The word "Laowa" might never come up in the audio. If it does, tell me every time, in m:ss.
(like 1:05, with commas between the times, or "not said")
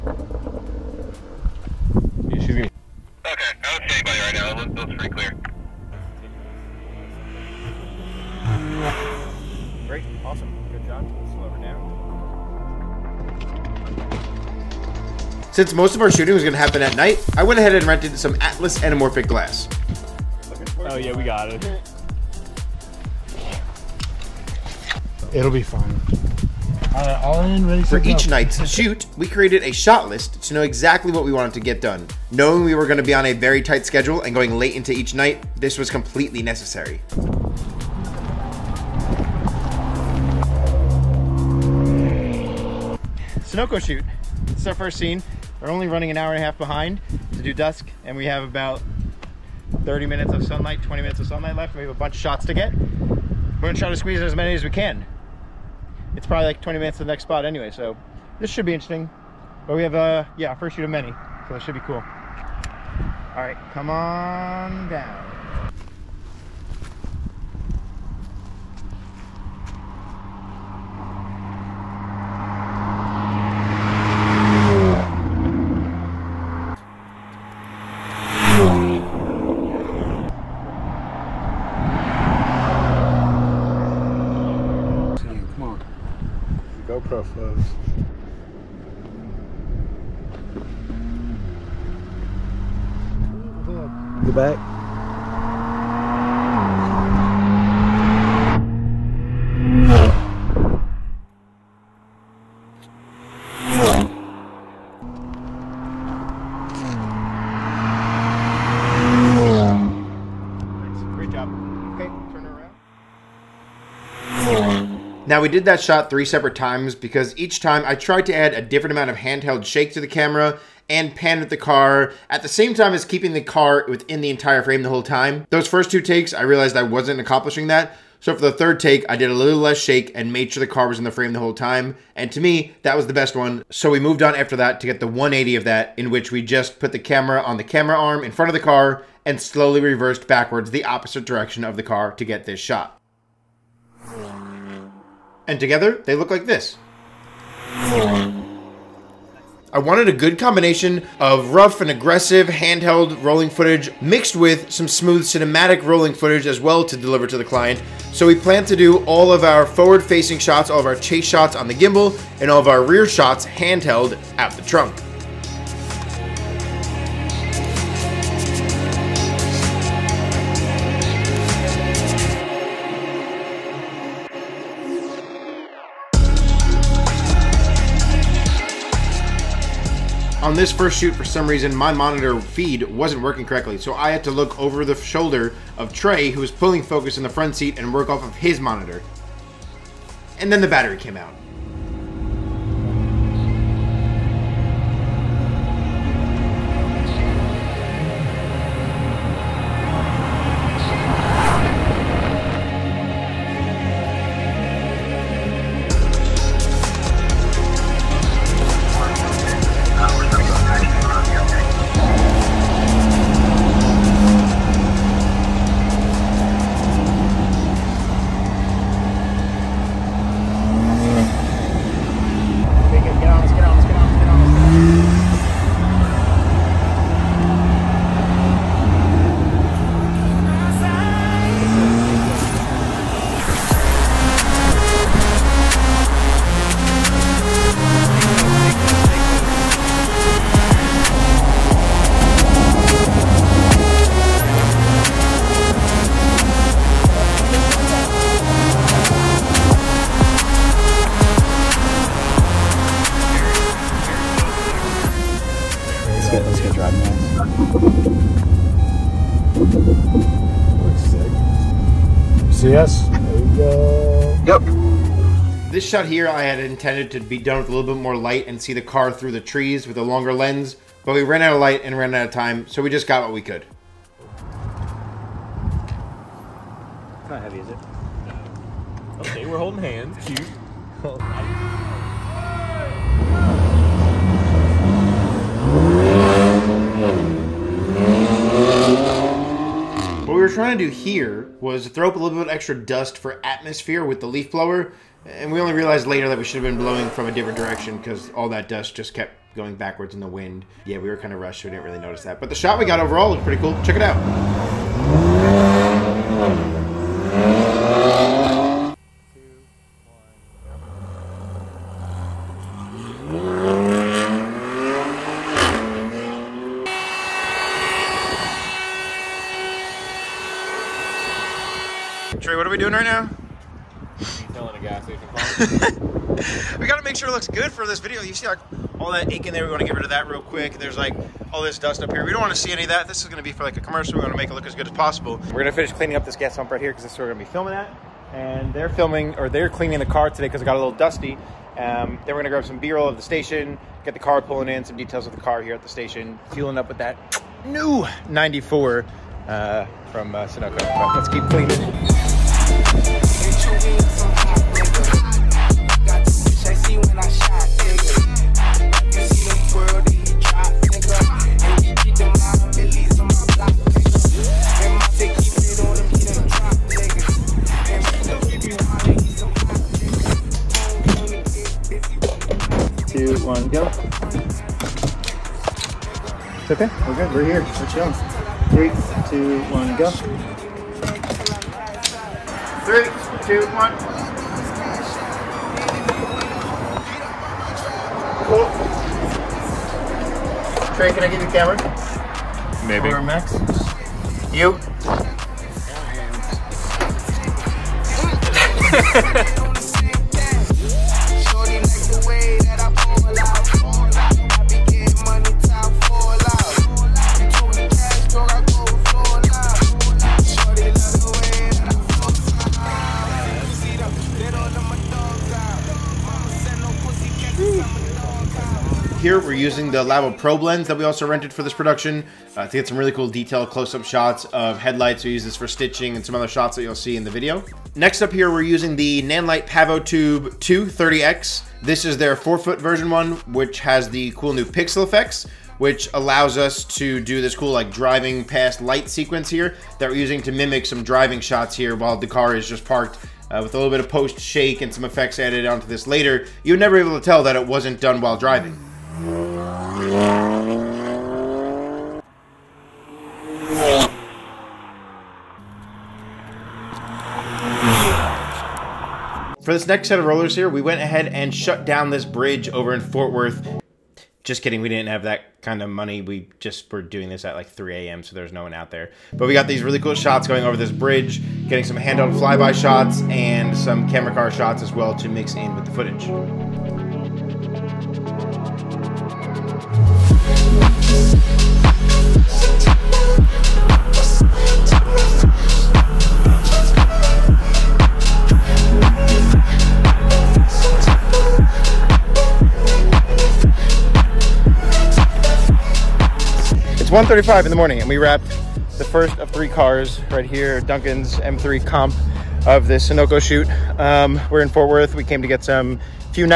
7:00.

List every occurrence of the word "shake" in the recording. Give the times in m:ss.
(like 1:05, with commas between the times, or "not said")
1:59, 2:09, 7:24.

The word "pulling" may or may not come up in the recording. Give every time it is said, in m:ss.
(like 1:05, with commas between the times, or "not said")
3:06, 5:44.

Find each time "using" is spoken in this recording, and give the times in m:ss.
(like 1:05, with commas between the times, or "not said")
6:59, 7:08, 7:20.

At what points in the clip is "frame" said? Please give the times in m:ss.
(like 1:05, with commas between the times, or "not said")
2:04, 2:11.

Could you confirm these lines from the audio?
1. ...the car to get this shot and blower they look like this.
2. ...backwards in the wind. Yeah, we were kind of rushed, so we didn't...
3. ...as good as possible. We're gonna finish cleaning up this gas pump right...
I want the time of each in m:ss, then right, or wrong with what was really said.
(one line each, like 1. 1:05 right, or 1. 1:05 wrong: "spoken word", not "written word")
1. 2:21 wrong: "together", not "blower"
2. 4:59 right
3. 5:34 right.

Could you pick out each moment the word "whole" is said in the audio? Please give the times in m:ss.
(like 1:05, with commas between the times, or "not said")
2:04, 2:11.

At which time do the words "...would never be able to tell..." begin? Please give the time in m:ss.
7:26.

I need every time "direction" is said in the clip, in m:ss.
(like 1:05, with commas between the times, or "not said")
2:21, 4:57.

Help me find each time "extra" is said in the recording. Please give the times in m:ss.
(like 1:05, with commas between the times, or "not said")
4:52.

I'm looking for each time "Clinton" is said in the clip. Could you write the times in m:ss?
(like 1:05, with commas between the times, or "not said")
not said.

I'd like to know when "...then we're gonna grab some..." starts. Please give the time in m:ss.
5:42.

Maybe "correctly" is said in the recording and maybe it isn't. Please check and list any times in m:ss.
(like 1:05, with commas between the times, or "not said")
3:03.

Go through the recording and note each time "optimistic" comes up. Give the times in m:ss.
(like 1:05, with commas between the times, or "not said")
not said.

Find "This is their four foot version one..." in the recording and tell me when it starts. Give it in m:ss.
7:11.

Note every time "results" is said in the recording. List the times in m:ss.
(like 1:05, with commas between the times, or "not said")
not said.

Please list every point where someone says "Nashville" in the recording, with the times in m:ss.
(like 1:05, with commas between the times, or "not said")
not said.